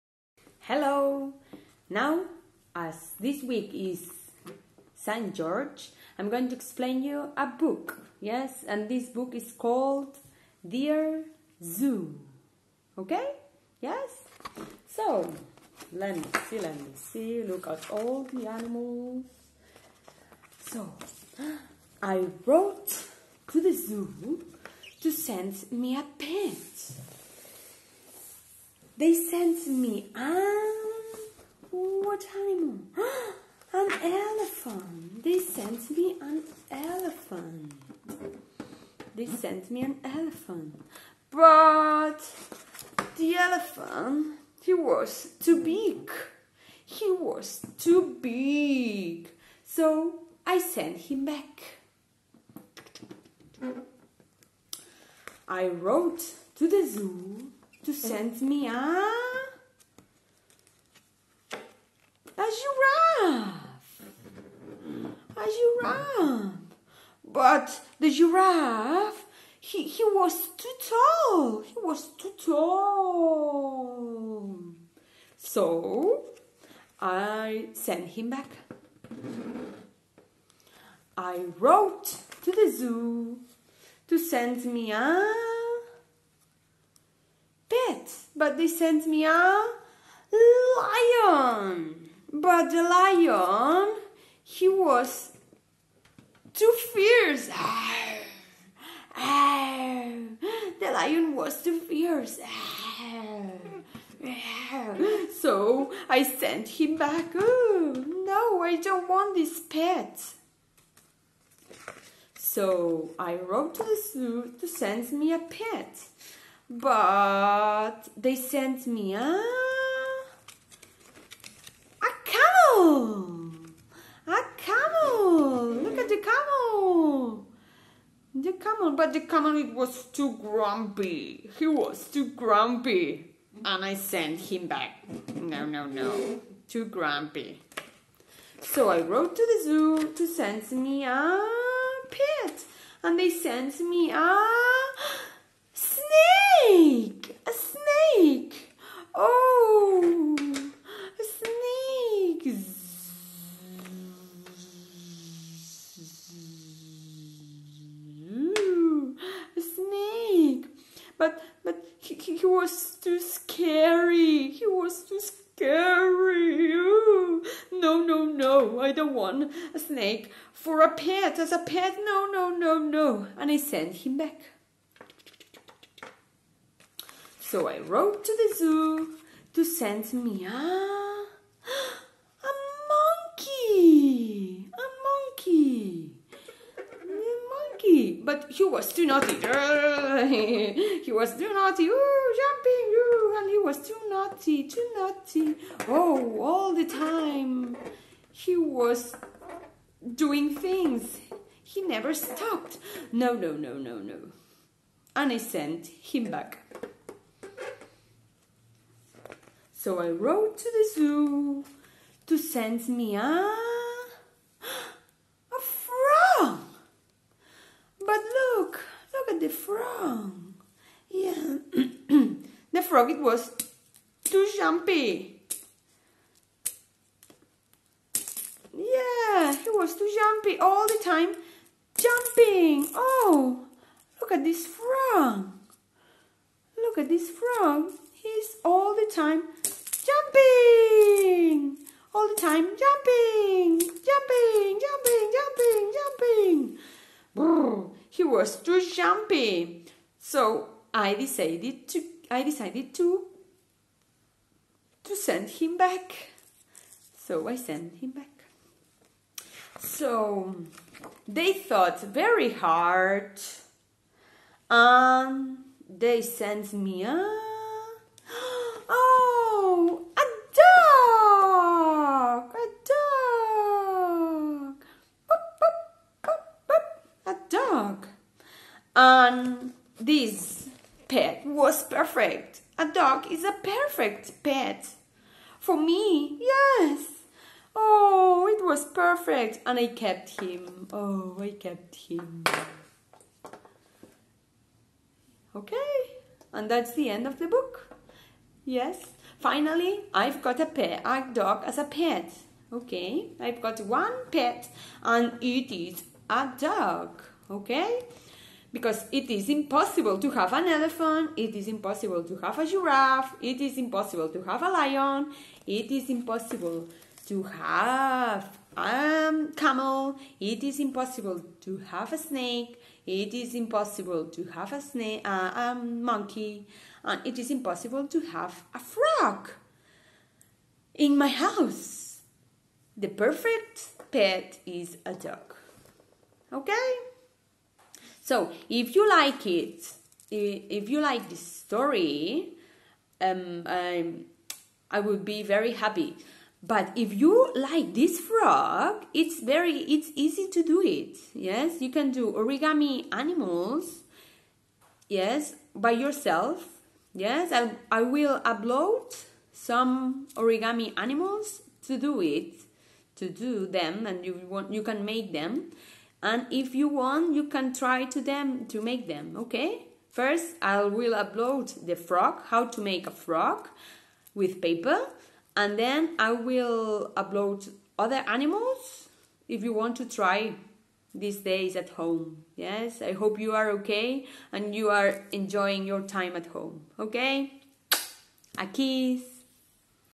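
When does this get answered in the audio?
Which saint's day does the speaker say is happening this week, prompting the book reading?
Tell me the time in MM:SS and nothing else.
00:04.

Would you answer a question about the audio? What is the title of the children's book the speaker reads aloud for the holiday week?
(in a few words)
Dear Zoo.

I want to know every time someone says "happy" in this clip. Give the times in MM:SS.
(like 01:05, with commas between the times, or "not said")
05:45.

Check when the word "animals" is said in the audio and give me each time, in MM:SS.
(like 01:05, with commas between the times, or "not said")
00:18, 00:32, 05:53, 06:00, 06:18.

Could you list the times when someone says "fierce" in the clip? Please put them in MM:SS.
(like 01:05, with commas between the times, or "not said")
01:36, 01:41.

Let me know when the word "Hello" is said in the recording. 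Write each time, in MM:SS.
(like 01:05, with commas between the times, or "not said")
00:00.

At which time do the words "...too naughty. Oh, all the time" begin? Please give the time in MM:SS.
03:14.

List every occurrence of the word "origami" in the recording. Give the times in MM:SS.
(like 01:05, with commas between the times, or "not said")
05:52, 06:00.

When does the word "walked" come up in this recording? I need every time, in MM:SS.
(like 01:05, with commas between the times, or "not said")
not said.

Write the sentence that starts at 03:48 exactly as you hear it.
Yeah, he was too jumpy all the time.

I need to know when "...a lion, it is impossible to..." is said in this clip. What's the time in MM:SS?
05:14.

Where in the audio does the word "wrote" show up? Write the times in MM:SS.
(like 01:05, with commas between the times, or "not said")
00:22, 00:55, 01:21, 01:53, 02:19, 02:57, 03:30.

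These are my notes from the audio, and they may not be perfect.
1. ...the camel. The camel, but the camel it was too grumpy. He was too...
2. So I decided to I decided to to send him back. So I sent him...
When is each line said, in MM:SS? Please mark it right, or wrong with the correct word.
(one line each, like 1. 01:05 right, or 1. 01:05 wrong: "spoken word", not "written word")
1. 02:06 right
2. 04:10 right.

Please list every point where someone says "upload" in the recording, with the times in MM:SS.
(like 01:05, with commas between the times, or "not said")
05:58, 06:11, 06:17.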